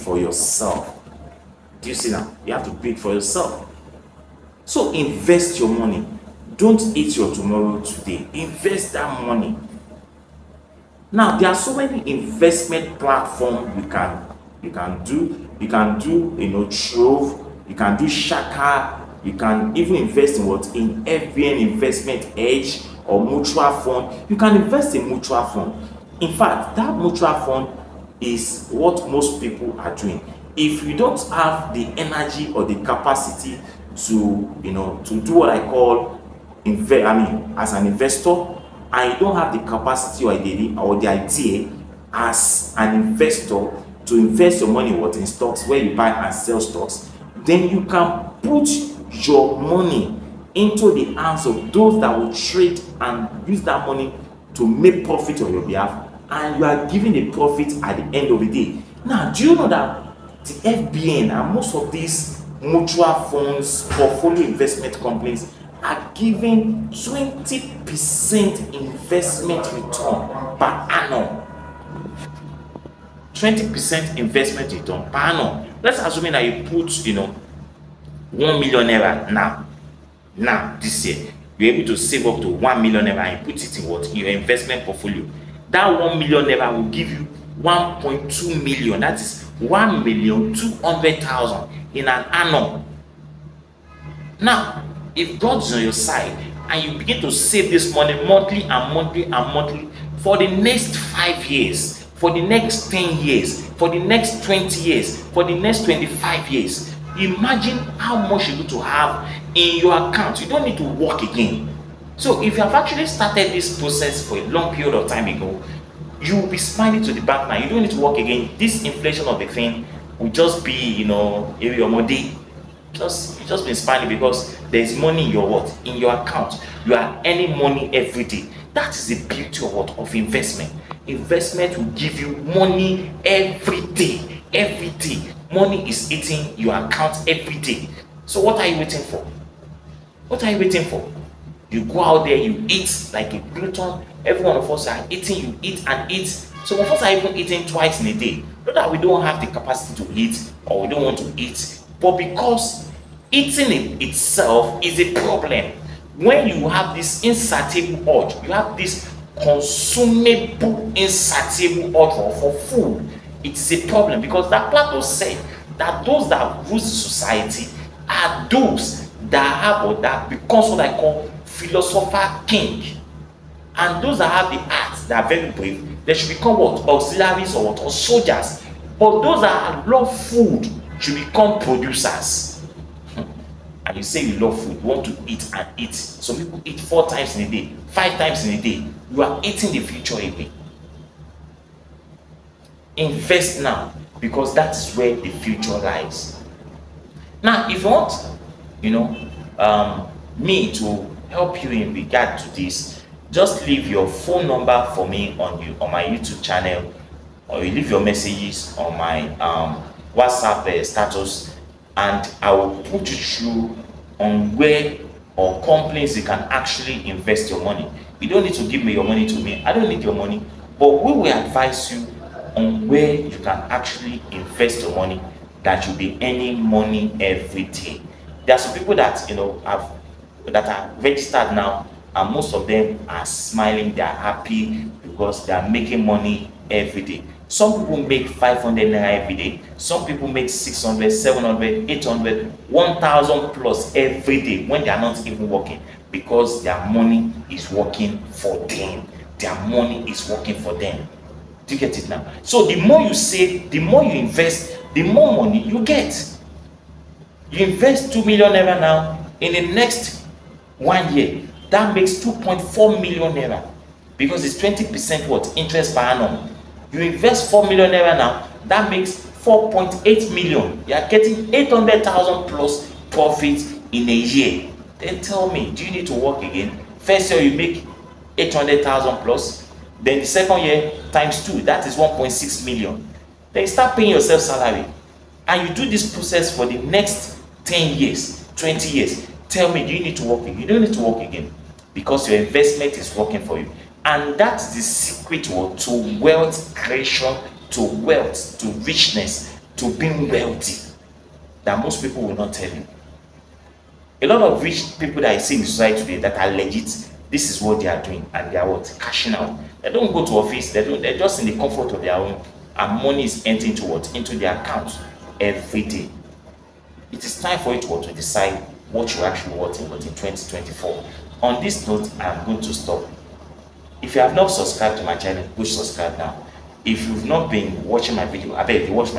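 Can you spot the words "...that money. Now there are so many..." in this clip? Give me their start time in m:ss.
0:08.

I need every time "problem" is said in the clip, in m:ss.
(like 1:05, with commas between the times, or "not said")
2:35, 2:43.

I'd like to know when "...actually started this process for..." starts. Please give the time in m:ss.
1:52.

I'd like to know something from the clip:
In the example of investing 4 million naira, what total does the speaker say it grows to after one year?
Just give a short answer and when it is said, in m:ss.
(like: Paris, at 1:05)
4.8 million, at 4:29.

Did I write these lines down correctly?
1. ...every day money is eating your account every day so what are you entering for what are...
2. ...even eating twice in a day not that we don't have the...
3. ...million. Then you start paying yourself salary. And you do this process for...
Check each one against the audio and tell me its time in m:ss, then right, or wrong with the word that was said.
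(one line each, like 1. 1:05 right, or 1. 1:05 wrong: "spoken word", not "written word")
1. 2:14 wrong: "waiting", not "entering"
2. 2:27 right
3. 4:42 right.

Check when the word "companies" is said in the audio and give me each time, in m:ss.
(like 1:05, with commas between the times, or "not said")
1:04, 3:35.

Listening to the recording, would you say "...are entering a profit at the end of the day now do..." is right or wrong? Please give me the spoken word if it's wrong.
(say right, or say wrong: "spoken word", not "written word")
wrong: "giving", not "entering".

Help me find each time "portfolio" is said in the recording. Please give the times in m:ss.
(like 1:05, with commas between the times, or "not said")
1:03, 1:24.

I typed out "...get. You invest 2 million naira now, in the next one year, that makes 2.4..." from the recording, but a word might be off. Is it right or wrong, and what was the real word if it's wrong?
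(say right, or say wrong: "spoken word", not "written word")
right.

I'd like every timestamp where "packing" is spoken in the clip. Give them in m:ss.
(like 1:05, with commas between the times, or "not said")
not said.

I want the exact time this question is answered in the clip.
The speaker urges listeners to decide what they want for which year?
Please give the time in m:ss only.
5:19.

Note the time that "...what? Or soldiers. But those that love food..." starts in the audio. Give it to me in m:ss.
2:57.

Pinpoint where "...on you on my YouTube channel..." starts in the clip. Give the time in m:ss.
3:25.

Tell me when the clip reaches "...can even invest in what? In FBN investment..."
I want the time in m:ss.
0:19.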